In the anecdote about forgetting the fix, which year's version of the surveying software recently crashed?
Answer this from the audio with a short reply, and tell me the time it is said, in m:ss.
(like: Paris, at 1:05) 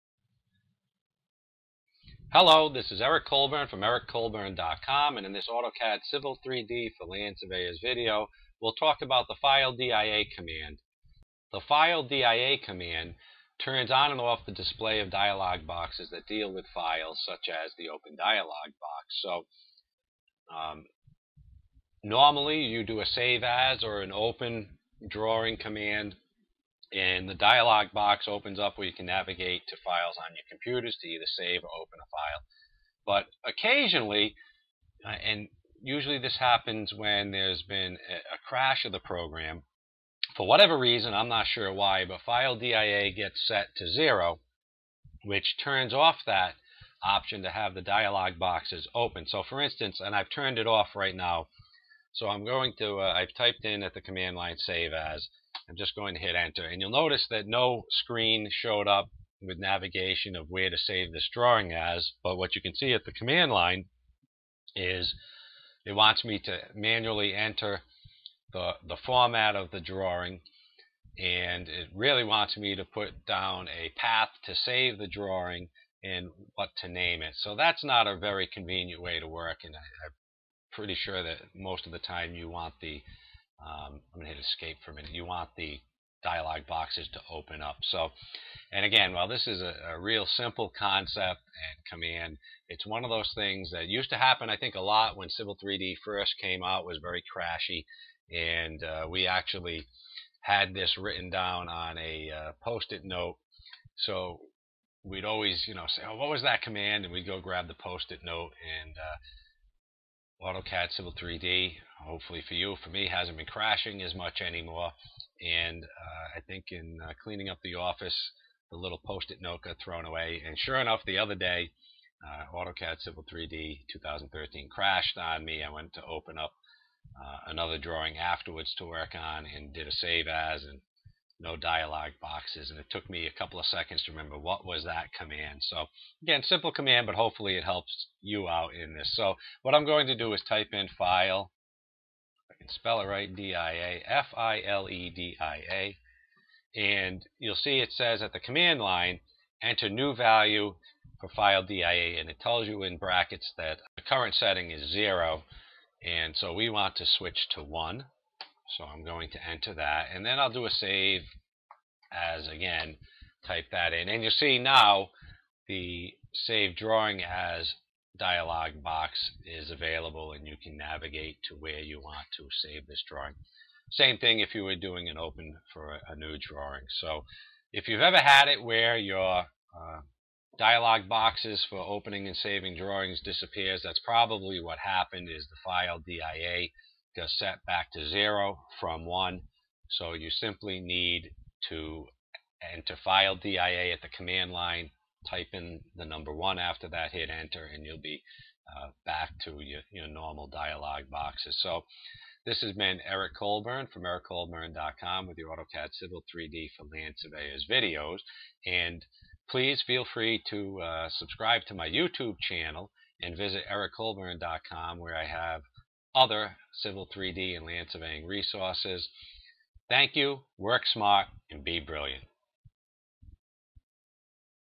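2013, at 2:03.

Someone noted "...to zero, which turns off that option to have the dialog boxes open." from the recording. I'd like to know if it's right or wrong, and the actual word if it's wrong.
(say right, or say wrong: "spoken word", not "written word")
right.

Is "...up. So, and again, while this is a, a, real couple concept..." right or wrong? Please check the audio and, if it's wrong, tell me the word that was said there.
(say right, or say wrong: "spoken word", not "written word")
wrong: "simple", not "couple".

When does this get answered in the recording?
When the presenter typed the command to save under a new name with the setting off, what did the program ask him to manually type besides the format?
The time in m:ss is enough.
1:13.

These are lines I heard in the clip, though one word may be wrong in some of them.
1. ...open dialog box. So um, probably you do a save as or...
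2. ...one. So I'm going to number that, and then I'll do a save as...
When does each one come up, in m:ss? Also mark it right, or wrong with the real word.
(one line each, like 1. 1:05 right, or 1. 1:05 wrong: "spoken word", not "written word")
1. 0:17 wrong: "normally", not "probably"
2. 2:37 wrong: "enter", not "number".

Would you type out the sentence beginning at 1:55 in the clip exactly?
And uh, I think in uh, cleaning up the office, the little post-it note got thrown away.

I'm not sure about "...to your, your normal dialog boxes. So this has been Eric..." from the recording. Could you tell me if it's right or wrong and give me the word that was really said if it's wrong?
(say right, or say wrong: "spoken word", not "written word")
right.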